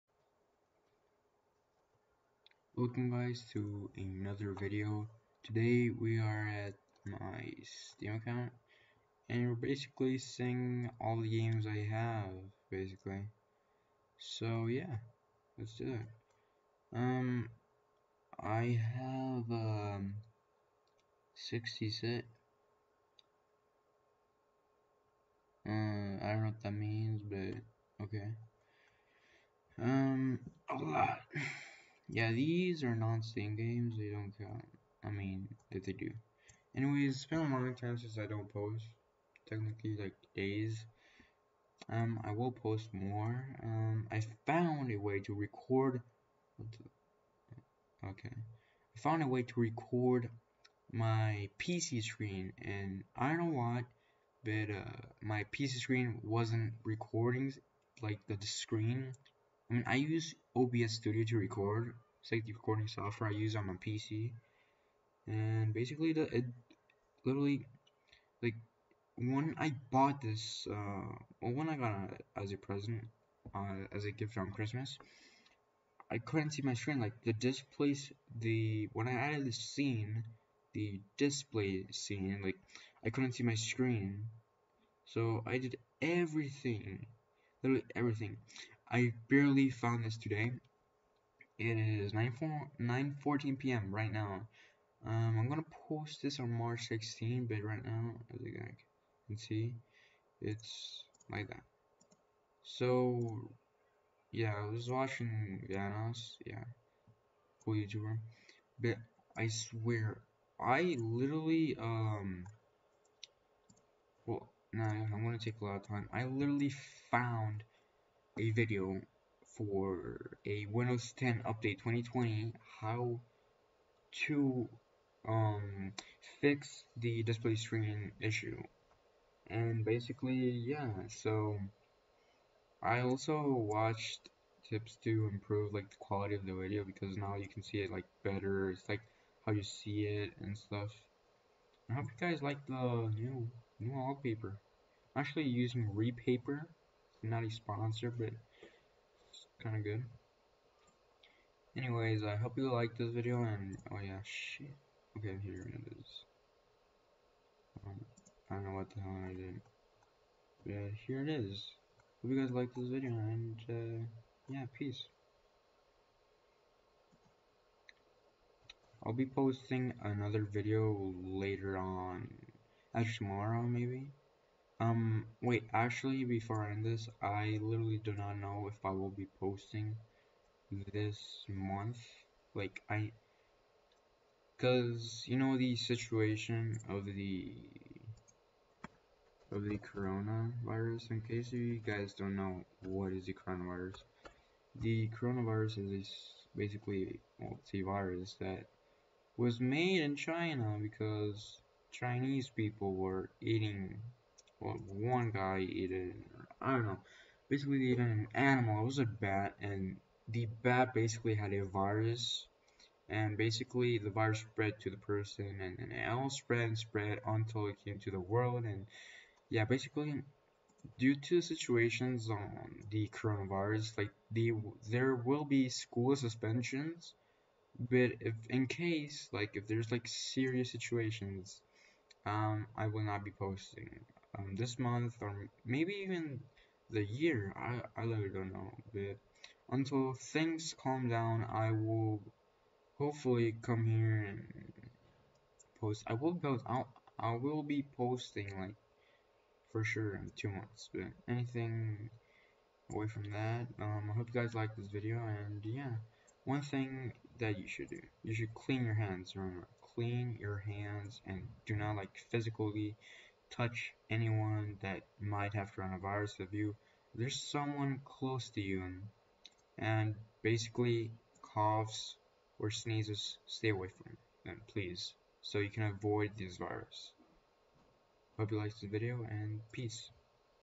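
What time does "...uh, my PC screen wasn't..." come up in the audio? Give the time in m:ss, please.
0:54.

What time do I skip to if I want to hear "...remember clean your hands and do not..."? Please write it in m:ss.
4:19.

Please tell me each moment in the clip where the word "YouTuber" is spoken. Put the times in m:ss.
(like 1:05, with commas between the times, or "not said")
1:47.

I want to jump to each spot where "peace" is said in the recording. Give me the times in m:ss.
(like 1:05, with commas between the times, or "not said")
2:44, 4:39.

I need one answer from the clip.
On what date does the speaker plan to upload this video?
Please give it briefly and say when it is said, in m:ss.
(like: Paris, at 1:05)
March 16, at 1:36.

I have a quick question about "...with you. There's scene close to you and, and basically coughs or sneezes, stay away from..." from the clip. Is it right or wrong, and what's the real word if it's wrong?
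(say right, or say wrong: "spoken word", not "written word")
wrong: "someone", not "scene".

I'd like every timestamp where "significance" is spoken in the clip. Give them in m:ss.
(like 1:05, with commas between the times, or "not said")
not said.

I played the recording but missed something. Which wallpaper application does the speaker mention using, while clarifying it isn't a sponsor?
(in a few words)
Repaper.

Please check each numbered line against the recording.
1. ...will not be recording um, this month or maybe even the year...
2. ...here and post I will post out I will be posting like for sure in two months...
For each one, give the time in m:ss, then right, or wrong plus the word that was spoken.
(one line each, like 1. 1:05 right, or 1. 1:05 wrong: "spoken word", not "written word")
1. 3:52 wrong: "posting", not "recording"
2. 4:03 right.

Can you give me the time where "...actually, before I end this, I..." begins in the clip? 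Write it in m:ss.
2:55.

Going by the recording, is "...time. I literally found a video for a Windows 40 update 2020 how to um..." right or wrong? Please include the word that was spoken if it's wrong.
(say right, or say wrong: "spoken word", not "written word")
wrong: "10", not "40".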